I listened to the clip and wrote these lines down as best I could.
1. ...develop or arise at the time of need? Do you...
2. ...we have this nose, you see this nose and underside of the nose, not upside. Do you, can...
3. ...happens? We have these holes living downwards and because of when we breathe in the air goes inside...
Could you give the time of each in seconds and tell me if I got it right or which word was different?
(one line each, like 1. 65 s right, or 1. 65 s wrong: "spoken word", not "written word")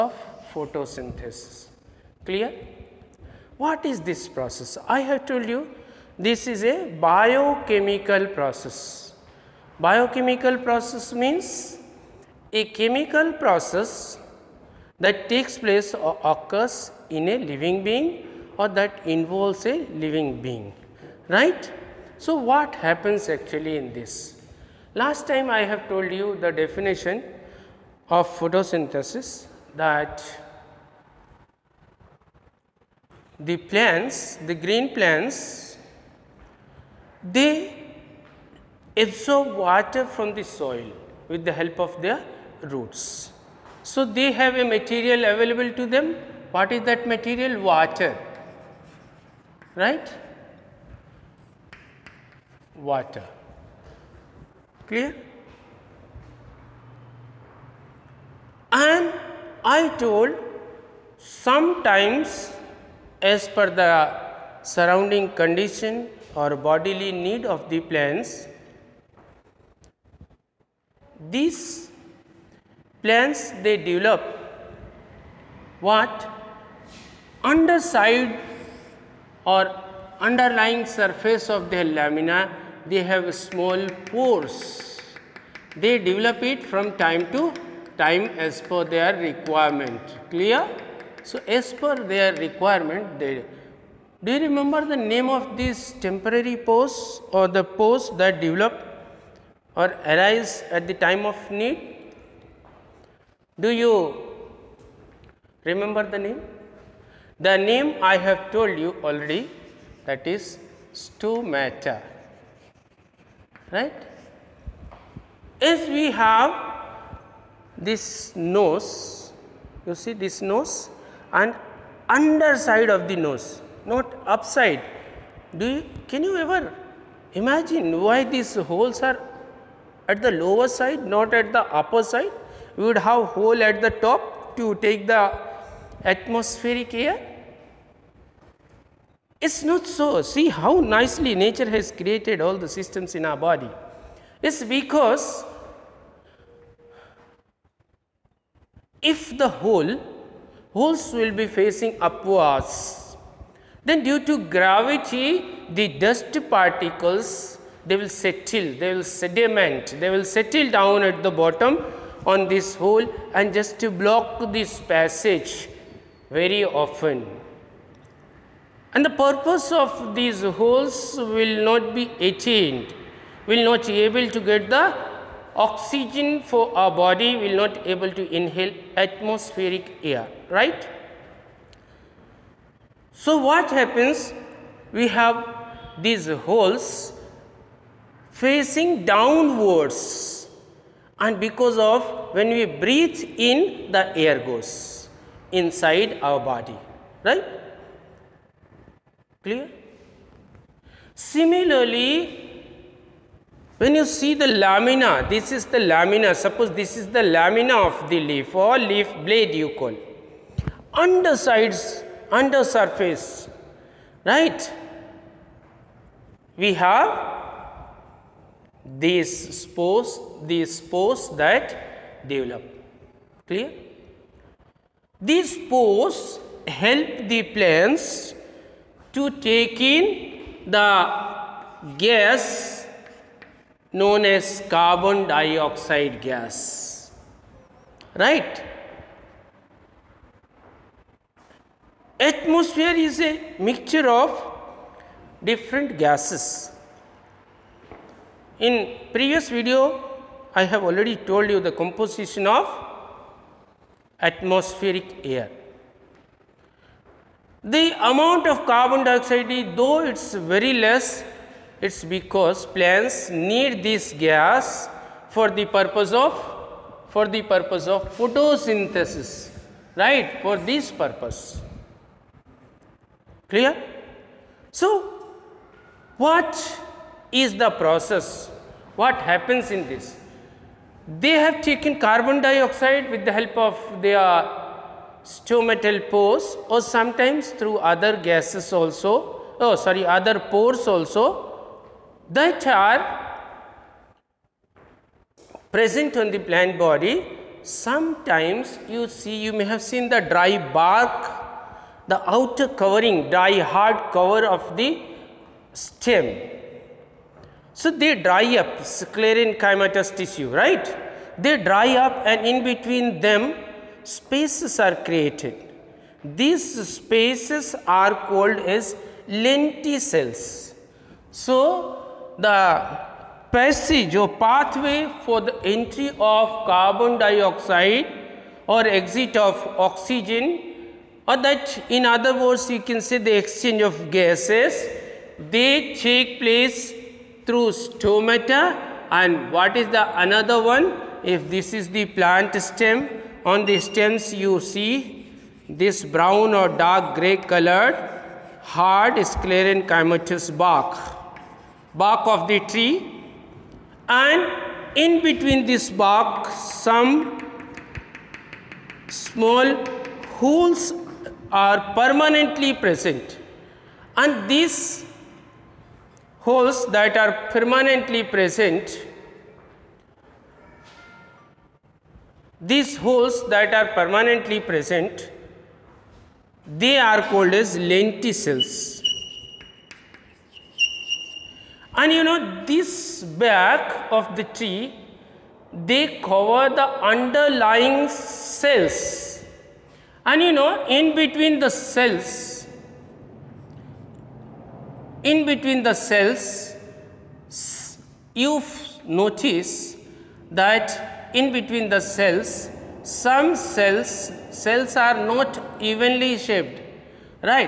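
1. 98 s right
2. 115 s right
3. 183 s wrong: "facing", not "living".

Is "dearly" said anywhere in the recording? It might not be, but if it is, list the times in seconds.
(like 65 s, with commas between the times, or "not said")
not said.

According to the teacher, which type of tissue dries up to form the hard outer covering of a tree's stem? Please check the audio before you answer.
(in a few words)
sclerenchymatous tissue.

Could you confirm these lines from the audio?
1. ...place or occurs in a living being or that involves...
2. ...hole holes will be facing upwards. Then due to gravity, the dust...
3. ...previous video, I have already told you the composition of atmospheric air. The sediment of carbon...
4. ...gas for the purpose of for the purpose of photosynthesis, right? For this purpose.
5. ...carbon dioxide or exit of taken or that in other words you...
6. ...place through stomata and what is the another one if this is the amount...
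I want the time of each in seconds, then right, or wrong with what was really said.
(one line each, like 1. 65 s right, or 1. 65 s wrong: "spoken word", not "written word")
1. 15 s right
2. 149 s right
3. 249 s wrong: "amount", not "sediment"
4. 264 s right
5. 326 s wrong: "oxygen", not "taken"
6. 336 s wrong: "plant", not "amount".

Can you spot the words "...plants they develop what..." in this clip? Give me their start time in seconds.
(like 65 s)
73 s.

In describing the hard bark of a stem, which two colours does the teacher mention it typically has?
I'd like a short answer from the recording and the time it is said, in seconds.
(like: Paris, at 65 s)
brown or dark gray, at 346 s.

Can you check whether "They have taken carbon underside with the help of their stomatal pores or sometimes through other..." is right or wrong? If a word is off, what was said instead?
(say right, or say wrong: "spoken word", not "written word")
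wrong: "dioxide", not "underside".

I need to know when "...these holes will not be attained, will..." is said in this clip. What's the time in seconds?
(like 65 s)
170 s.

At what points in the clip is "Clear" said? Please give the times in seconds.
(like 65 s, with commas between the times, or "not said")
2 s, 54 s, 90 s, 199 s, 223 s, 273 s.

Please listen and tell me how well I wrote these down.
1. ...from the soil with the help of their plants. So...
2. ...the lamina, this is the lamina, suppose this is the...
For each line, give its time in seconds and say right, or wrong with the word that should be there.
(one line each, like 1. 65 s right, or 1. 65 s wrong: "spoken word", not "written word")
1. 40 s wrong: "roots", not "plants"
2. 204 s right.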